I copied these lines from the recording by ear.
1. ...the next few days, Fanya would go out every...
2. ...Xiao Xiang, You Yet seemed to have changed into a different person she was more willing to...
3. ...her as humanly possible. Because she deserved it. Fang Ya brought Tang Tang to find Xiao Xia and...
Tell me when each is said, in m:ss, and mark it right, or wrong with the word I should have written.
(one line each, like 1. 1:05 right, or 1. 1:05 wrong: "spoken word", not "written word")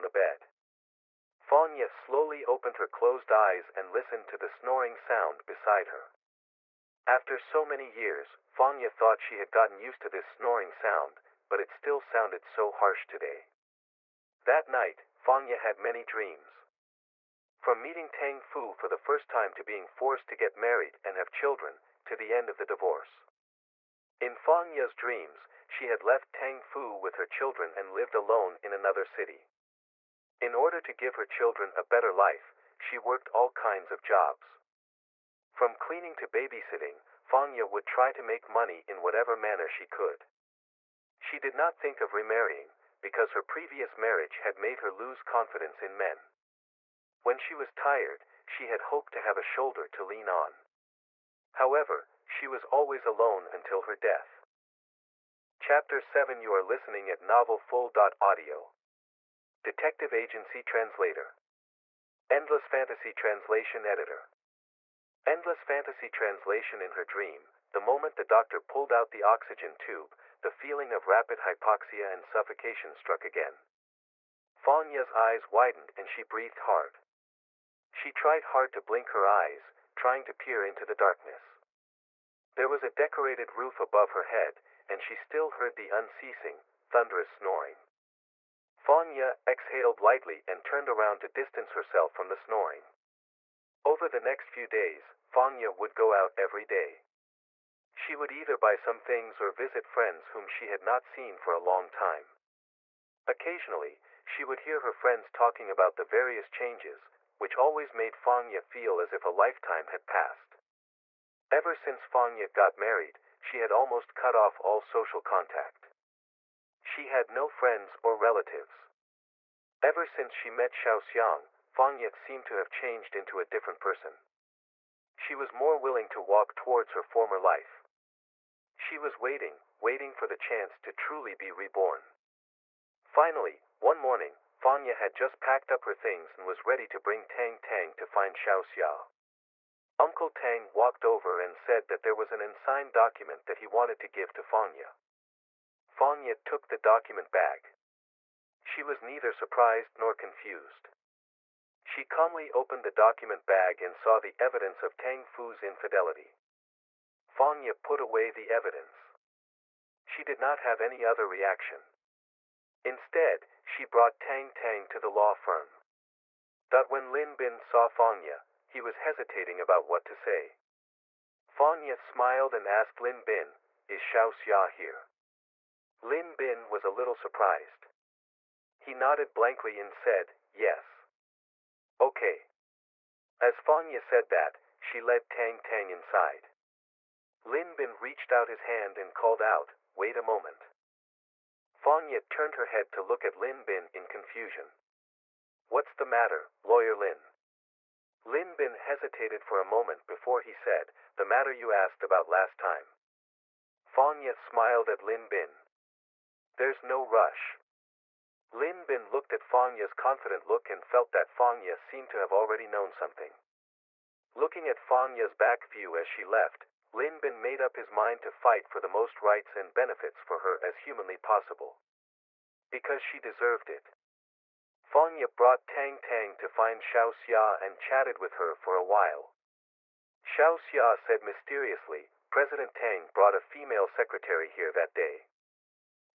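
1. 1:34 right
2. 2:00 wrong: "Fang", not "You"
3. 3:40 right.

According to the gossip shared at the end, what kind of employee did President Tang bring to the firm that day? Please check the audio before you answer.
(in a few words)
A female secretary.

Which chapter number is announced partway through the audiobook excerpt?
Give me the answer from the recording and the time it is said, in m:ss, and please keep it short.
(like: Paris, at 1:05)
7, at 0:55.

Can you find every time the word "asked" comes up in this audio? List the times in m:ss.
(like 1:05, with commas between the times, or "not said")
2:52, 3:21.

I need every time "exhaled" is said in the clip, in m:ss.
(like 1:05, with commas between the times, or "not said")
1:29.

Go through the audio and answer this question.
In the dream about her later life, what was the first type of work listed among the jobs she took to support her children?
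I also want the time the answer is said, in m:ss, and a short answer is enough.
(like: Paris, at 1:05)
Cleaning, at 0:35.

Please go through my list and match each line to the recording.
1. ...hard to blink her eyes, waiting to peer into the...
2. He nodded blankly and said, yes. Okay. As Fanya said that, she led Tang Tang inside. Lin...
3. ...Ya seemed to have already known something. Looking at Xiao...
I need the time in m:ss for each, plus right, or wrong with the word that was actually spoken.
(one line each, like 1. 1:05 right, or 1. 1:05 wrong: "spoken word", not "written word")
1. 1:18 wrong: "trying", not "waiting"
2. 2:58 right
3. 3:31 wrong: "Fang", not "Xiao".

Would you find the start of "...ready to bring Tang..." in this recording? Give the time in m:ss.
2:16.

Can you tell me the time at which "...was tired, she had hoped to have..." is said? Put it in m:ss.
0:47.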